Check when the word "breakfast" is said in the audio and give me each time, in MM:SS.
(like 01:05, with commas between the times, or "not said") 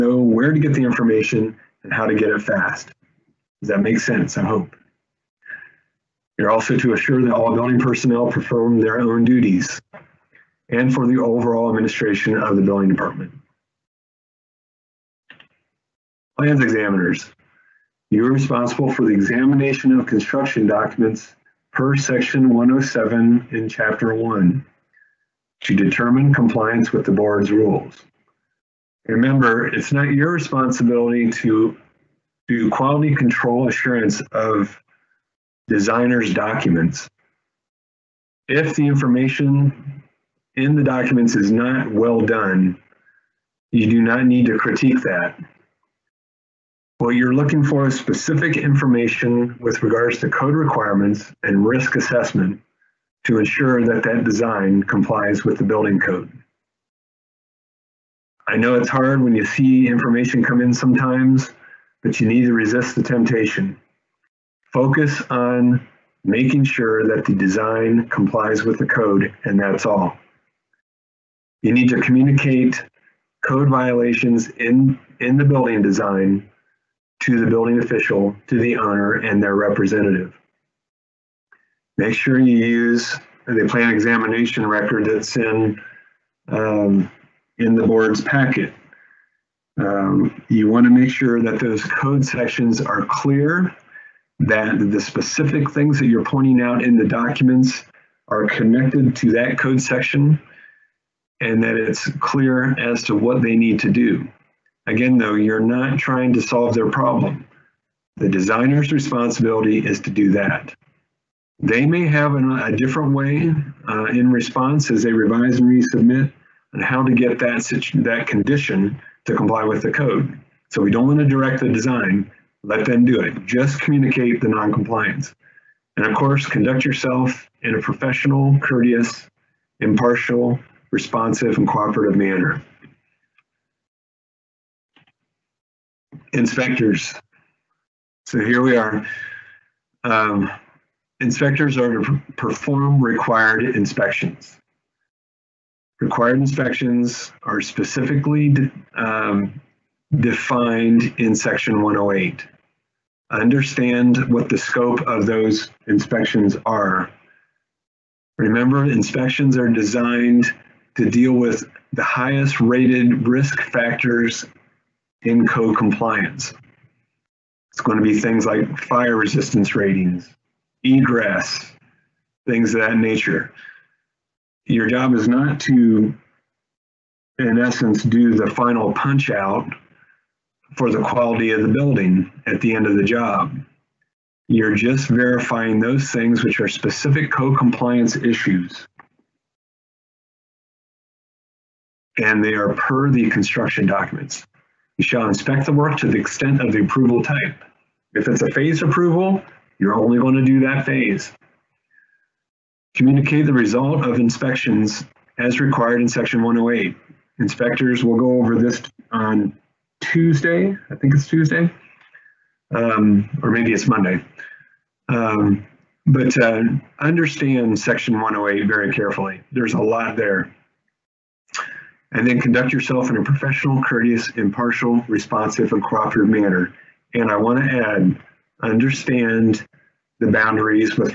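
not said.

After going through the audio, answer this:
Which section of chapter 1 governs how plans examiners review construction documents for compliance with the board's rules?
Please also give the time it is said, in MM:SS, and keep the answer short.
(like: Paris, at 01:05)
Section 107, at 00:21.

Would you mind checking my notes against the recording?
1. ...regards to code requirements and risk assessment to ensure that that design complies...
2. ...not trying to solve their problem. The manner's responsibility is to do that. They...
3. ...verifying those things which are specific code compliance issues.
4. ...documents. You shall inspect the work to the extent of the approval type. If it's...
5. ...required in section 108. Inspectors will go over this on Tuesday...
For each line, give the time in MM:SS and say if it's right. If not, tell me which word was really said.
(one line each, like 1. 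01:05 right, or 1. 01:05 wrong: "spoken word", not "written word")
1. 00:49 right
2. 01:45 wrong: "designer", not "manner"
3. 03:05 right
4. 03:13 right
5. 03:25 right.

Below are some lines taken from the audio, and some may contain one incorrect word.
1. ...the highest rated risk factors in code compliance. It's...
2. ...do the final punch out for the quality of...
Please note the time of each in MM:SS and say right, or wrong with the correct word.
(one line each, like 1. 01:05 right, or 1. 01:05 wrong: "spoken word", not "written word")
1. 02:41 right
2. 02:58 right.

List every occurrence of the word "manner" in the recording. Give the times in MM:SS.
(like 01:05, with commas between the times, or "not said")
02:12, 03:46.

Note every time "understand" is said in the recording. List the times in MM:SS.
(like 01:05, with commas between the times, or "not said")
02:33, 03:36, 03:48.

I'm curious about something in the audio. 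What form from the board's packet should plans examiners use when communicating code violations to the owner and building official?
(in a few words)
Plan examination record.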